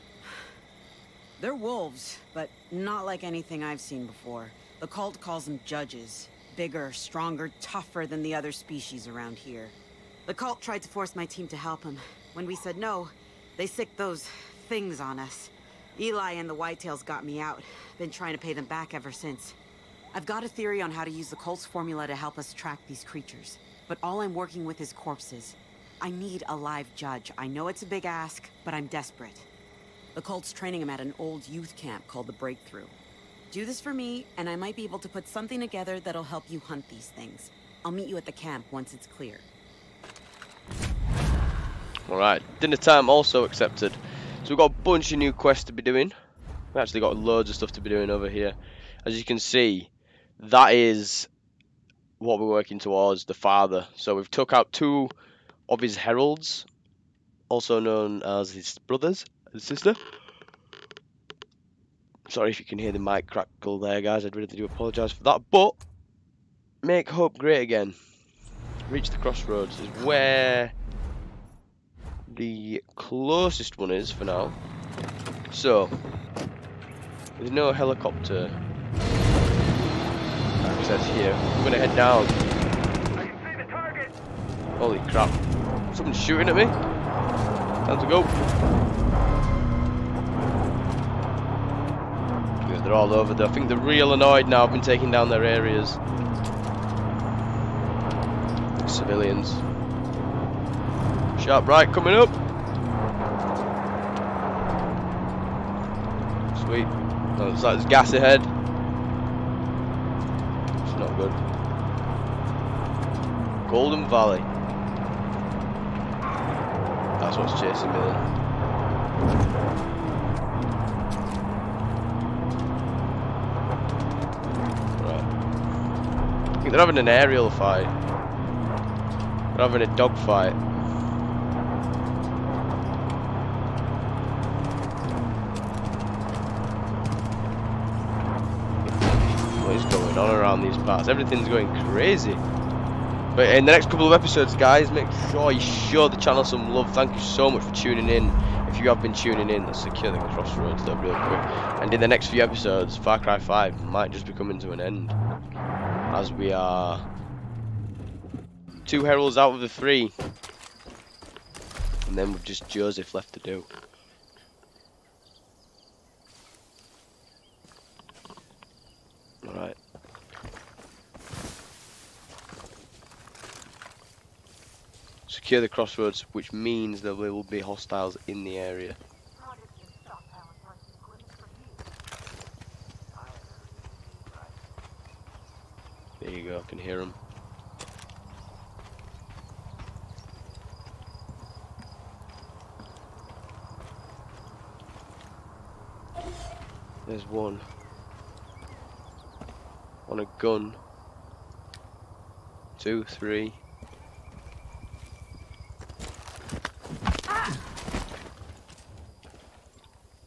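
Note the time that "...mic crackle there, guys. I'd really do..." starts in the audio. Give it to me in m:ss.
1:02.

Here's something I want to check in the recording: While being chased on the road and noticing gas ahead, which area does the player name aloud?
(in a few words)
Golden Valley.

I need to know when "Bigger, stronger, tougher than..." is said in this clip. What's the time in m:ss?
0:06.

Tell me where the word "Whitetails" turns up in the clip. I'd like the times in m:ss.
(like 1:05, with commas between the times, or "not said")
0:16.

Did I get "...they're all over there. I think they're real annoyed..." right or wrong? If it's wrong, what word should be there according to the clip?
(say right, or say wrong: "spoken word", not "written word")
right.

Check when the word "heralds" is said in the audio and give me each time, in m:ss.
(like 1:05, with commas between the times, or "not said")
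0:55, 2:39.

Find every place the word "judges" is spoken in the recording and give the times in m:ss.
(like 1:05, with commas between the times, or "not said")
0:05, 0:26.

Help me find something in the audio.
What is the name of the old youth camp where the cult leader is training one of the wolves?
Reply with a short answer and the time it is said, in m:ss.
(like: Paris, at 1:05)
The Breakthrough, at 0:32.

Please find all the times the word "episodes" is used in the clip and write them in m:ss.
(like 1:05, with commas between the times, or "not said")
2:24, 2:32.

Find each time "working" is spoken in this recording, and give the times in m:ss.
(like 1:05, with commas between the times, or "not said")
0:24, 0:52.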